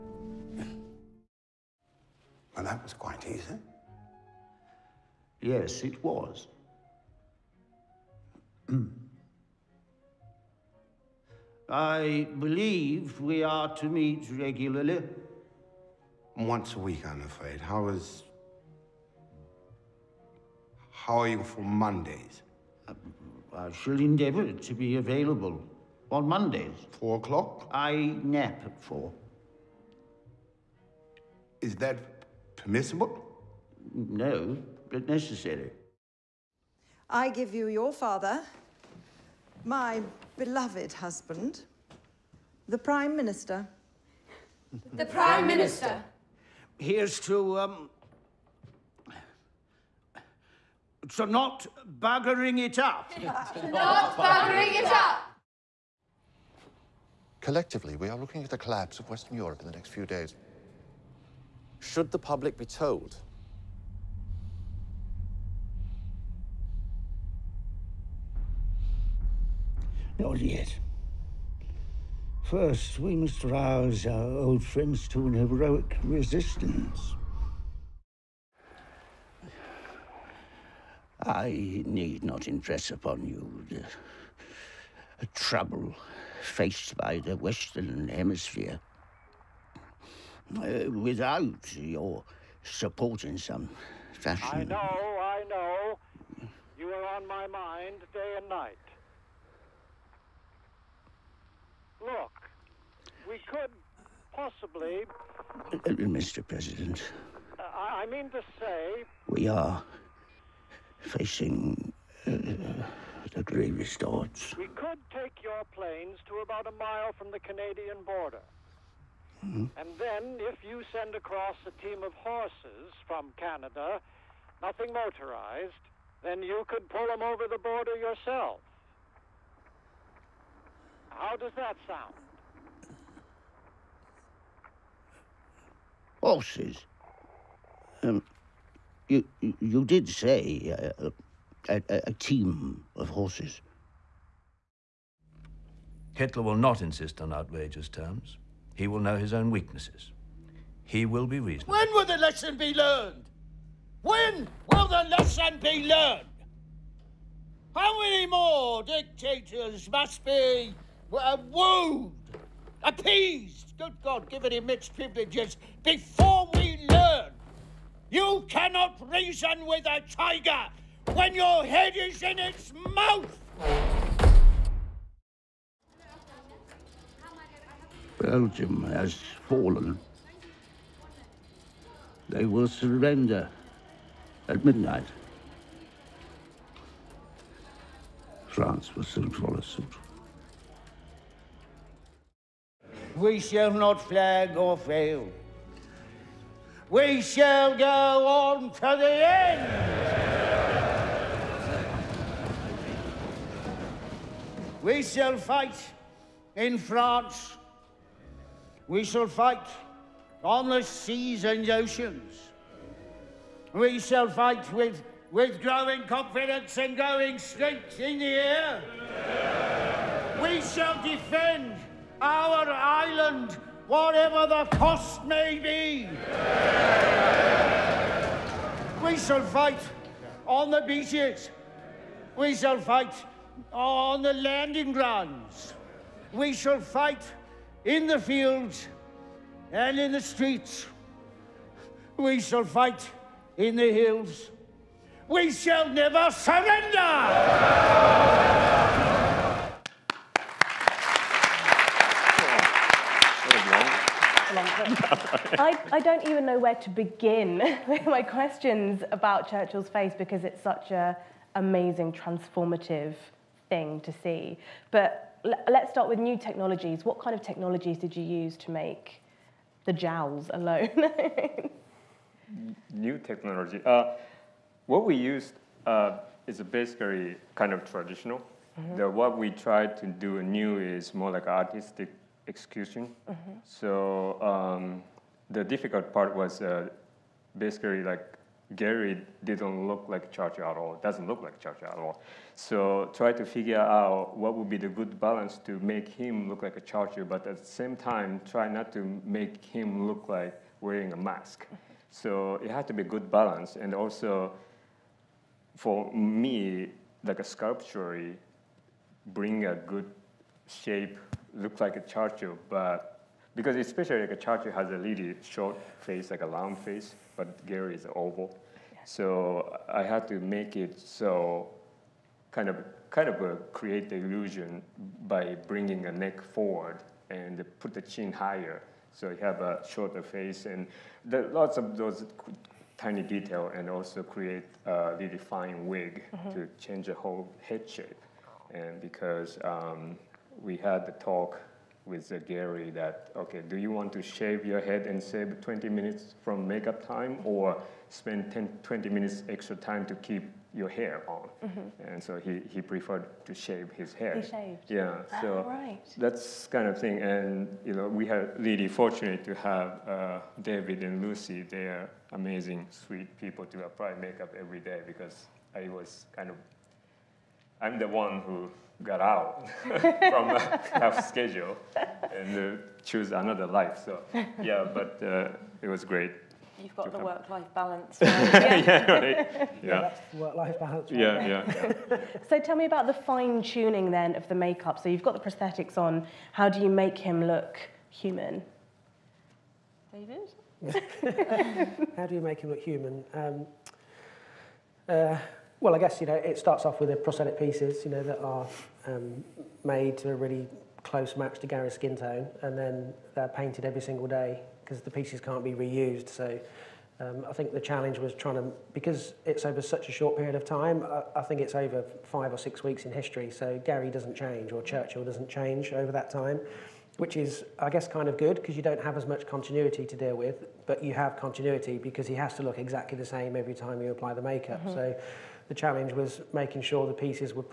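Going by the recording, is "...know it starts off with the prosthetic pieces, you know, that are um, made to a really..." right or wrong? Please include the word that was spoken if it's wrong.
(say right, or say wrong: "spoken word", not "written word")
right.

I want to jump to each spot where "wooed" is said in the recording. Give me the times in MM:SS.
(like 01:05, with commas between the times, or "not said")
02:41.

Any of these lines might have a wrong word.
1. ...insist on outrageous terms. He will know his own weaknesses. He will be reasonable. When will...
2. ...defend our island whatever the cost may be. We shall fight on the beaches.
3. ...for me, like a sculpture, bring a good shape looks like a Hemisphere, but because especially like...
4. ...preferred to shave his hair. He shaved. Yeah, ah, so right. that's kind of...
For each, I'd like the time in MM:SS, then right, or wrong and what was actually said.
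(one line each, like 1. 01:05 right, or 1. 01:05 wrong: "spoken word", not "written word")
1. 02:26 right
2. 03:41 right
3. 05:05 wrong: "Churchill", not "Hemisphere"
4. 05:52 right.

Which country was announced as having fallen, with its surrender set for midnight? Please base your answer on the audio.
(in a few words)
Belgium.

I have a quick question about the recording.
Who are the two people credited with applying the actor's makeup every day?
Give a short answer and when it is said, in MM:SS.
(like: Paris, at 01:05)
David and Lucy, at 06:00.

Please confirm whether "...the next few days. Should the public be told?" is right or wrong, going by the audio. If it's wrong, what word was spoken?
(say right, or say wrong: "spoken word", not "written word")
right.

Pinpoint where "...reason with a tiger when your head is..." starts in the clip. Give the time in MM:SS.
02:49.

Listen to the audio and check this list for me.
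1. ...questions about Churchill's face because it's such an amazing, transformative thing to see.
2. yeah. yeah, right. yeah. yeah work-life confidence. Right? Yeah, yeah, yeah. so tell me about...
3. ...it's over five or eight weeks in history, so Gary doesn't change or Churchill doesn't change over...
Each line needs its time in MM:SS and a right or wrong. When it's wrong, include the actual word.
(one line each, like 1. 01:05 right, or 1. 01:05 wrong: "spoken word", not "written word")
1. 04:18 right
2. 06:18 wrong: "balance", not "confidence"
3. 06:51 wrong: "six", not "eight".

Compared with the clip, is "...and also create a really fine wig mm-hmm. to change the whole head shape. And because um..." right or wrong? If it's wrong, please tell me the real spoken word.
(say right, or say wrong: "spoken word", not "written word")
right.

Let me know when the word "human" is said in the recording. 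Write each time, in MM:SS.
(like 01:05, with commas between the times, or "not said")
06:28, 06:32.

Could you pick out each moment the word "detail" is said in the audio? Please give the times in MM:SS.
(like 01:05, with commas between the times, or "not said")
05:33.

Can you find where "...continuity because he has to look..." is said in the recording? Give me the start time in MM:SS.
07:01.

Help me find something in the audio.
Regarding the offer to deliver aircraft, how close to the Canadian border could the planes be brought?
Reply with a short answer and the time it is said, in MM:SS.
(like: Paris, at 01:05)
About a mile, at 01:56.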